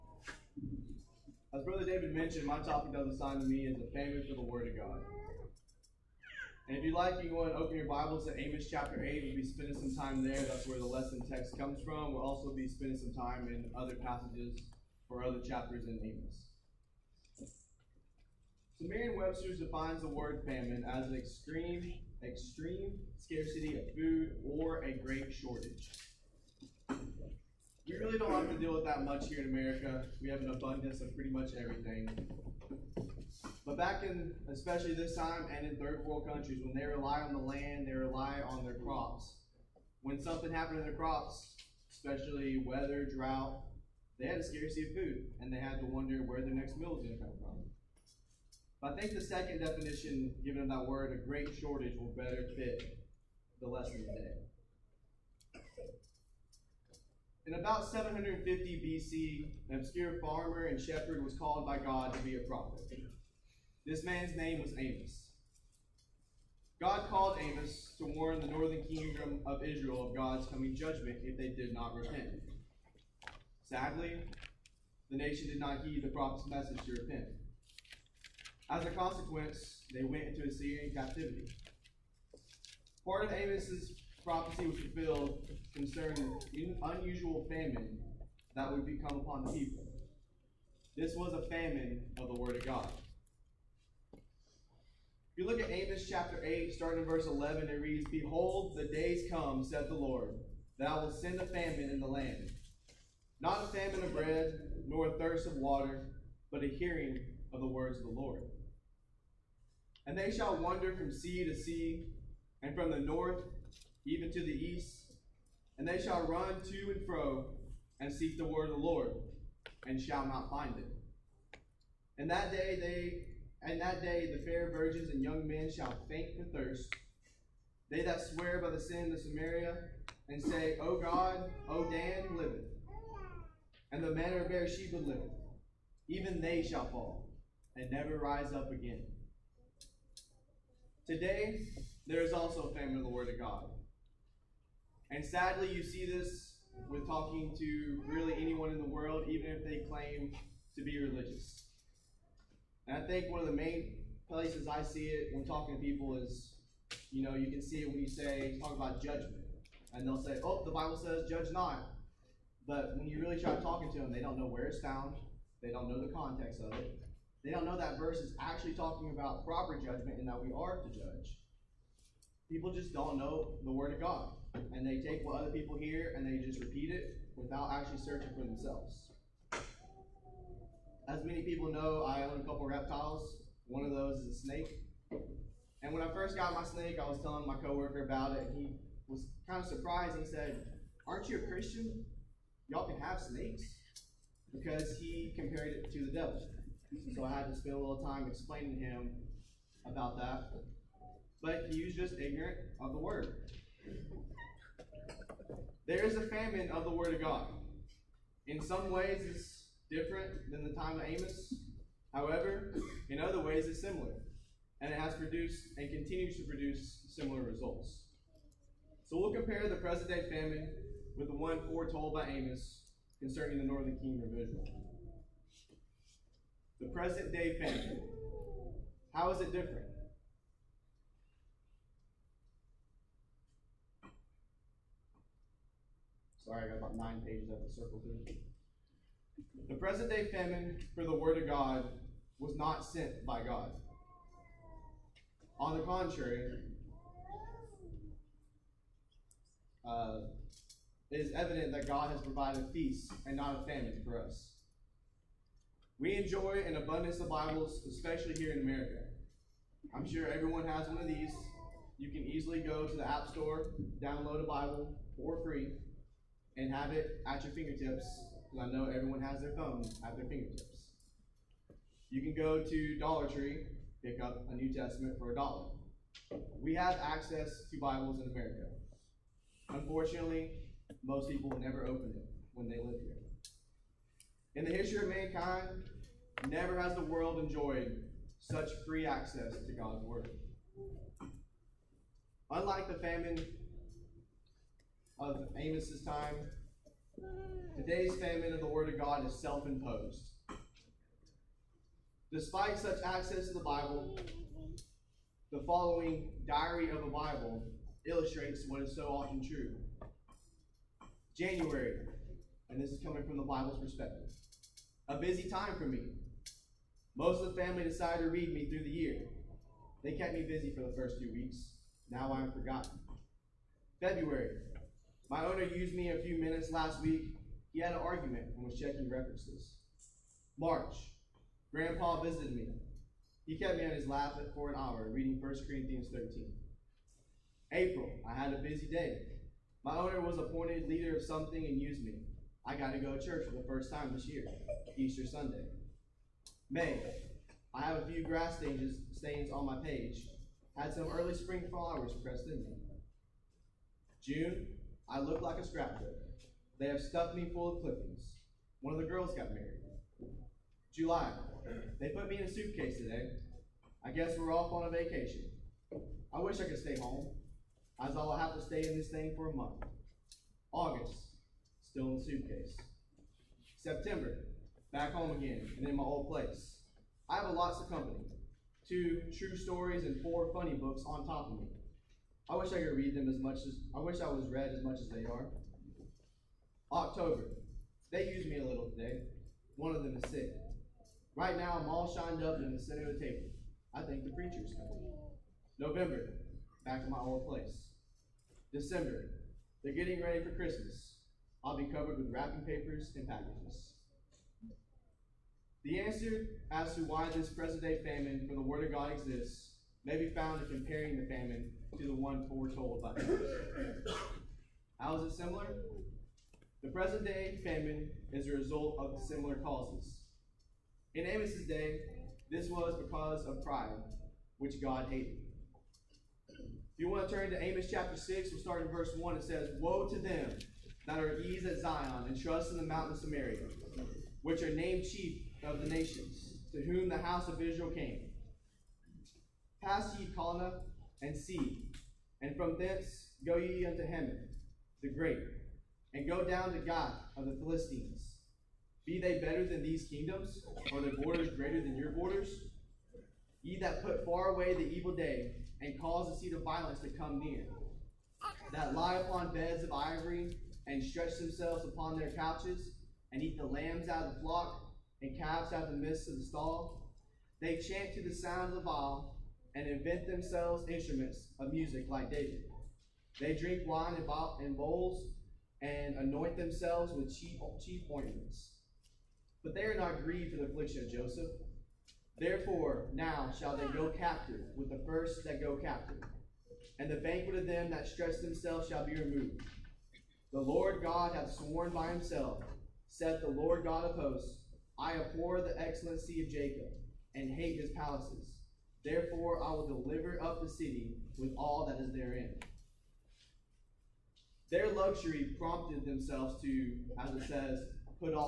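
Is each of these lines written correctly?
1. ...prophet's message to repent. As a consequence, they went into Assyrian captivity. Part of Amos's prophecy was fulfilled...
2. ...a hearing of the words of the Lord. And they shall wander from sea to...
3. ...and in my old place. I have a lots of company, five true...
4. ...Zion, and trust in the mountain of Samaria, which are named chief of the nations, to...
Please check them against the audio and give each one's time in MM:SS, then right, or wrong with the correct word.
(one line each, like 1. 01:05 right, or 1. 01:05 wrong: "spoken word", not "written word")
1. 01:16 right
2. 01:46 right
3. 06:15 wrong: "two", not "five"
4. 07:11 right.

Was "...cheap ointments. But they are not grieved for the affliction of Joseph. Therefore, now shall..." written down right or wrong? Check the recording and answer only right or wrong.
right.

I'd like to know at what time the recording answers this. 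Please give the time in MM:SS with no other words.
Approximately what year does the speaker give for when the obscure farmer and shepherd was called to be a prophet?
00:57.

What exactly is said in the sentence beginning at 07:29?
Be they better than these kingdoms, or their borders greater than your borders?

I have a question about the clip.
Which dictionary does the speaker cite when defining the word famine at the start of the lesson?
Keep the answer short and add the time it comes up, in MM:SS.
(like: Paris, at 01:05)
Merriam-Webster, at 00:18.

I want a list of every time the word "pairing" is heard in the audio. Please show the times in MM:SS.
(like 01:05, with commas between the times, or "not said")
not said.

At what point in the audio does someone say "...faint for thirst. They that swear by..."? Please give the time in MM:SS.
02:06.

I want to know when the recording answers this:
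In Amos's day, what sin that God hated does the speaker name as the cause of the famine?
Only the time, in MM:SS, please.
07:03.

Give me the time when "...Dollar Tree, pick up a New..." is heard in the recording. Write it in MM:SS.
04:32.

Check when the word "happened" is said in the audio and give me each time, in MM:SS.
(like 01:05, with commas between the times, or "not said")
00:40.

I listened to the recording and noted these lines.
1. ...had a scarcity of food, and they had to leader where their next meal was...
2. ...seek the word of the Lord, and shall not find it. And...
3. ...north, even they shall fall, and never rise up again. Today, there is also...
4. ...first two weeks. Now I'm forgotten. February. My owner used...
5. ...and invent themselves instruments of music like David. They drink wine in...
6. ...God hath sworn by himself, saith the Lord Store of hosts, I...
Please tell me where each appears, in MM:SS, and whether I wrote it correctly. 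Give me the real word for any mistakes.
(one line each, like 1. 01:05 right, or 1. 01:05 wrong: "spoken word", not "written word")
1. 00:44 wrong: "wonder", not "leader"
2. 01:58 right
3. 02:14 wrong: "liveth", not "north"
4. 05:20 right
5. 07:49 right
6. 08:11 wrong: "God", not "Store".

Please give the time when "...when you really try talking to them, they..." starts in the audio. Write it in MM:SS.
02:42.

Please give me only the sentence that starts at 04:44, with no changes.
In the history of mankind, never has the world enjoyed such free access to God's Word.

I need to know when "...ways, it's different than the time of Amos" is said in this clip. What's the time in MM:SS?
03:28.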